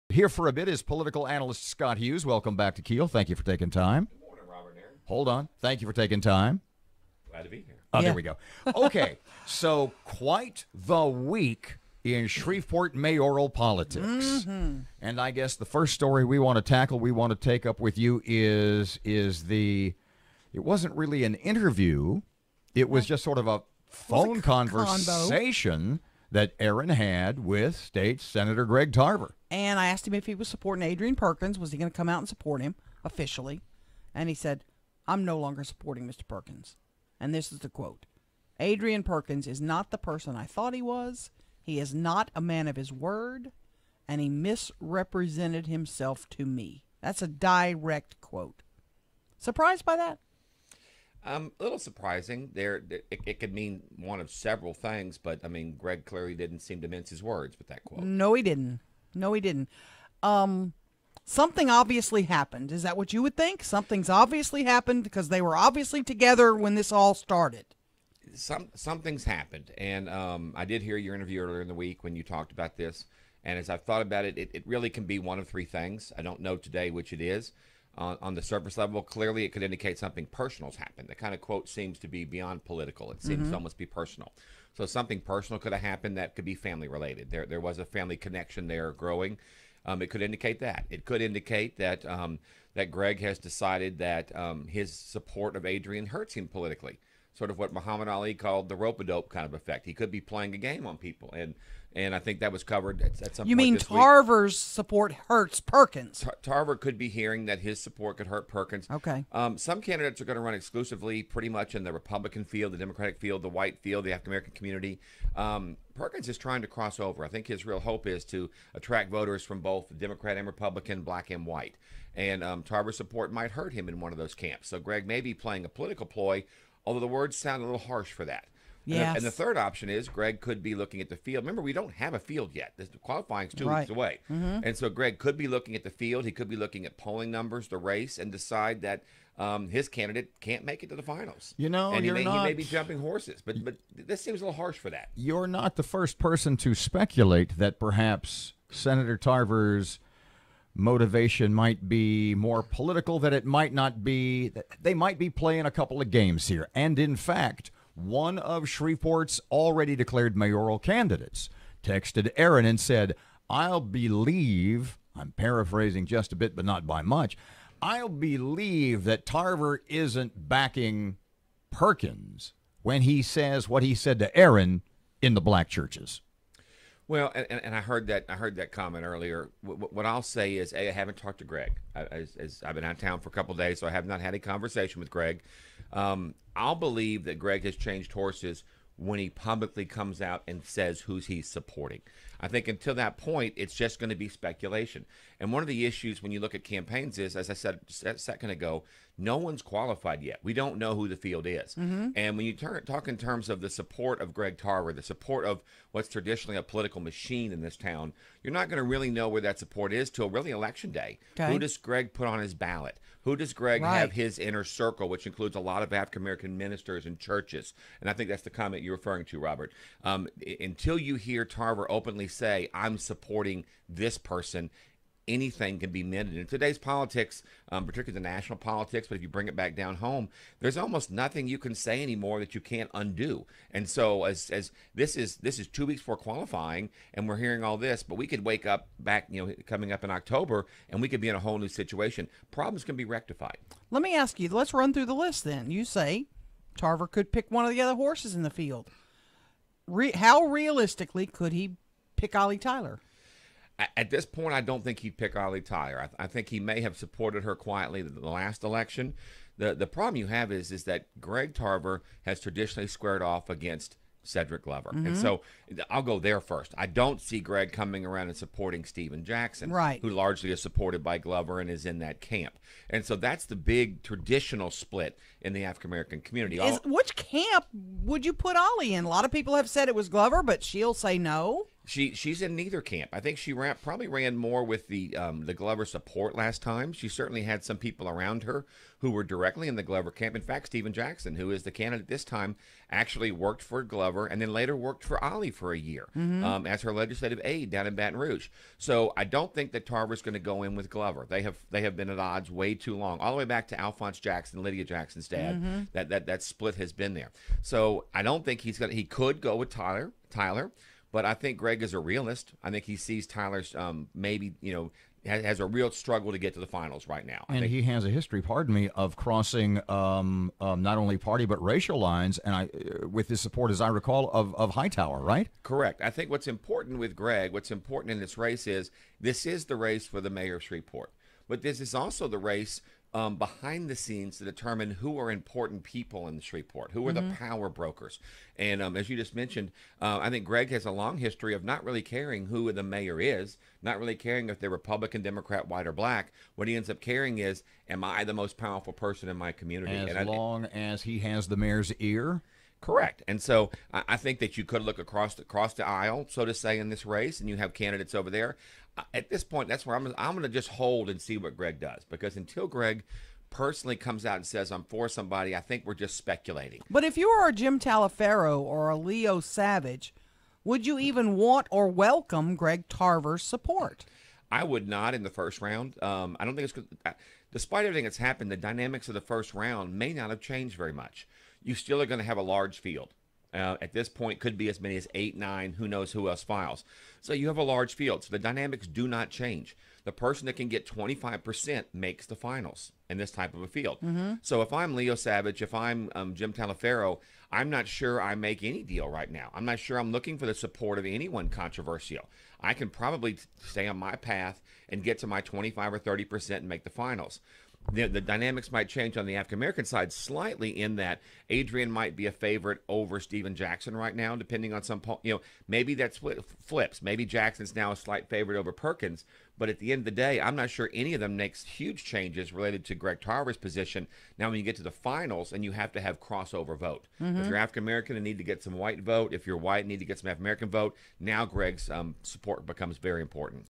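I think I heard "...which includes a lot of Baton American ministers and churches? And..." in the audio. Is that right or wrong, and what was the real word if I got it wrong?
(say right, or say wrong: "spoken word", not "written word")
wrong: "African", not "Baton".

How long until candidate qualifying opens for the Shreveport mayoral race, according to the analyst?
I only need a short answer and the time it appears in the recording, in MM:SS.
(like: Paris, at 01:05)
2 weeks, at 02:13.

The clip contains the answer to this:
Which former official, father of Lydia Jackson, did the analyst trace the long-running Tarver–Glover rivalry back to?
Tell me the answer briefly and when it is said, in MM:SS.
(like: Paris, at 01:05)
Alphonse Jackson, at 05:03.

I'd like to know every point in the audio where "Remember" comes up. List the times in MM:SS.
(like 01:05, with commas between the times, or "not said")
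02:11.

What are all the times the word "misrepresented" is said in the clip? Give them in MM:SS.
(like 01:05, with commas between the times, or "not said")
00:44.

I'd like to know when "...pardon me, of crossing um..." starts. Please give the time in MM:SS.
05:18.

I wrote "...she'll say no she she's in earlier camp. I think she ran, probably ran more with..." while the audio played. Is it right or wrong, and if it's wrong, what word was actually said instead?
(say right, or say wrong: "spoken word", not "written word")
wrong: "neither", not "earlier".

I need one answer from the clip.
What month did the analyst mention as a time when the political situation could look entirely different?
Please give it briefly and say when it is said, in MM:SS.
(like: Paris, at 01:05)
October, at 04:00.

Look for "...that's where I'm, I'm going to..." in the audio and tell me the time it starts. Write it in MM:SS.
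05:59.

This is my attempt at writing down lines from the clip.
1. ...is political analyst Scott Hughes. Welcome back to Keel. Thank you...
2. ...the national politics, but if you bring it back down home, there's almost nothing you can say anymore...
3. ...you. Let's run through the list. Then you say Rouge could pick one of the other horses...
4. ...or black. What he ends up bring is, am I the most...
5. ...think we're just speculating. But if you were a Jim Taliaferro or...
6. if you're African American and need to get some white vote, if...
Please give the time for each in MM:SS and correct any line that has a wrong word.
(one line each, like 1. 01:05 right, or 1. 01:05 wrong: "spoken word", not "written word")
1. 00:00 right
2. 03:48 right
3. 04:04 wrong: "Tarver", not "Rouge"
4. 05:45 wrong: "caring", not "bring"
5. 06:05 right
6. 07:07 right.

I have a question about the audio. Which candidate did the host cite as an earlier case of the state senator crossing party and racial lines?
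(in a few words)
Hightower.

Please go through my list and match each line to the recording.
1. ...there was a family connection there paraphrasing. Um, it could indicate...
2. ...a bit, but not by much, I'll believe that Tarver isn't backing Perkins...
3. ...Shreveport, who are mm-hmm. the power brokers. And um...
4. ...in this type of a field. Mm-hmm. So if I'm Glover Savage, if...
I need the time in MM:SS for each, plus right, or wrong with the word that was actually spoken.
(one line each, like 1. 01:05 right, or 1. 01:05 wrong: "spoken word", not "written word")
1. 01:27 wrong: "growing", not "paraphrasing"
2. 02:46 right
3. 05:36 right
4. 06:33 wrong: "Leo", not "Glover".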